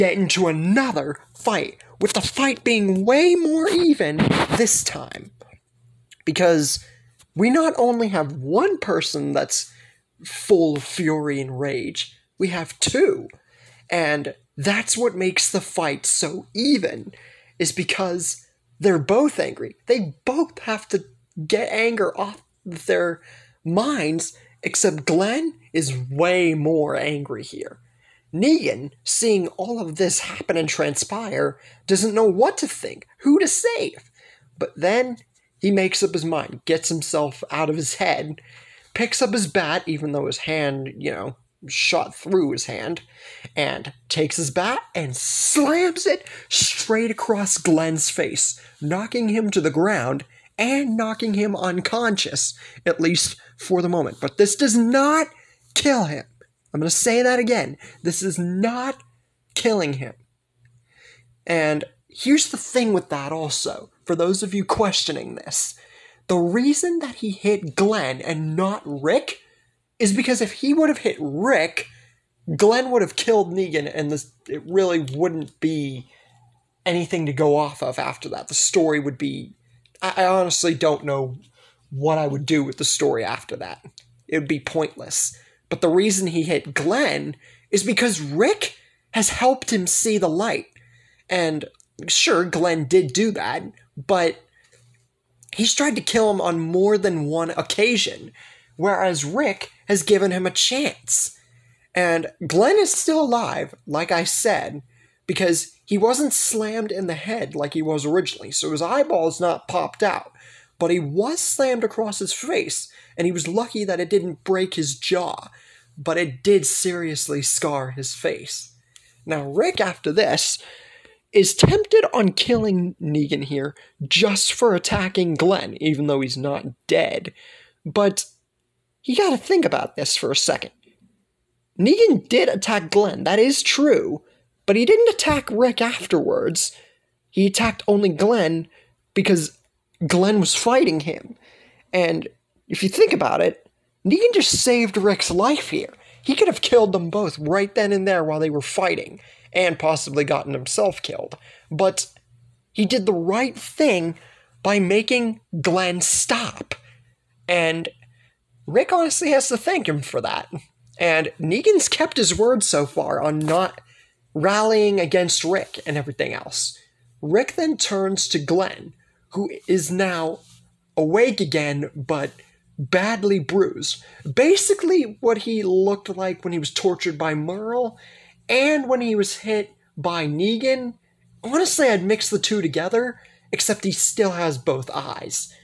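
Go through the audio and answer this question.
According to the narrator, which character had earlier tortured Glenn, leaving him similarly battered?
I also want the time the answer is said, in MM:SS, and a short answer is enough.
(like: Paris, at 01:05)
Merle, at 02:57.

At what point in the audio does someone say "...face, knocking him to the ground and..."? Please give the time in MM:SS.
00:48.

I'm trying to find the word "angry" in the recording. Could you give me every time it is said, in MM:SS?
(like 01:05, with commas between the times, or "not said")
00:19, 00:26.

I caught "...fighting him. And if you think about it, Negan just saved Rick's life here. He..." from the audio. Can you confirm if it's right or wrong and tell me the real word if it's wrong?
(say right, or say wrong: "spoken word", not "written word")
right.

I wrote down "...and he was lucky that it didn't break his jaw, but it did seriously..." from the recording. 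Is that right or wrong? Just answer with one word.
right.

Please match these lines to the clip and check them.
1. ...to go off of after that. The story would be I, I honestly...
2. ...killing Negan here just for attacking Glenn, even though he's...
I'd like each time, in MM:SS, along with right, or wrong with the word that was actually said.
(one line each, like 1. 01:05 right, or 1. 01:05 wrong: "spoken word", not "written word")
1. 01:17 right
2. 02:02 right.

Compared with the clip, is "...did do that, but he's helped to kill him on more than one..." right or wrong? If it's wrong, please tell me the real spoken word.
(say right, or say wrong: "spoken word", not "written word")
wrong: "tried", not "helped".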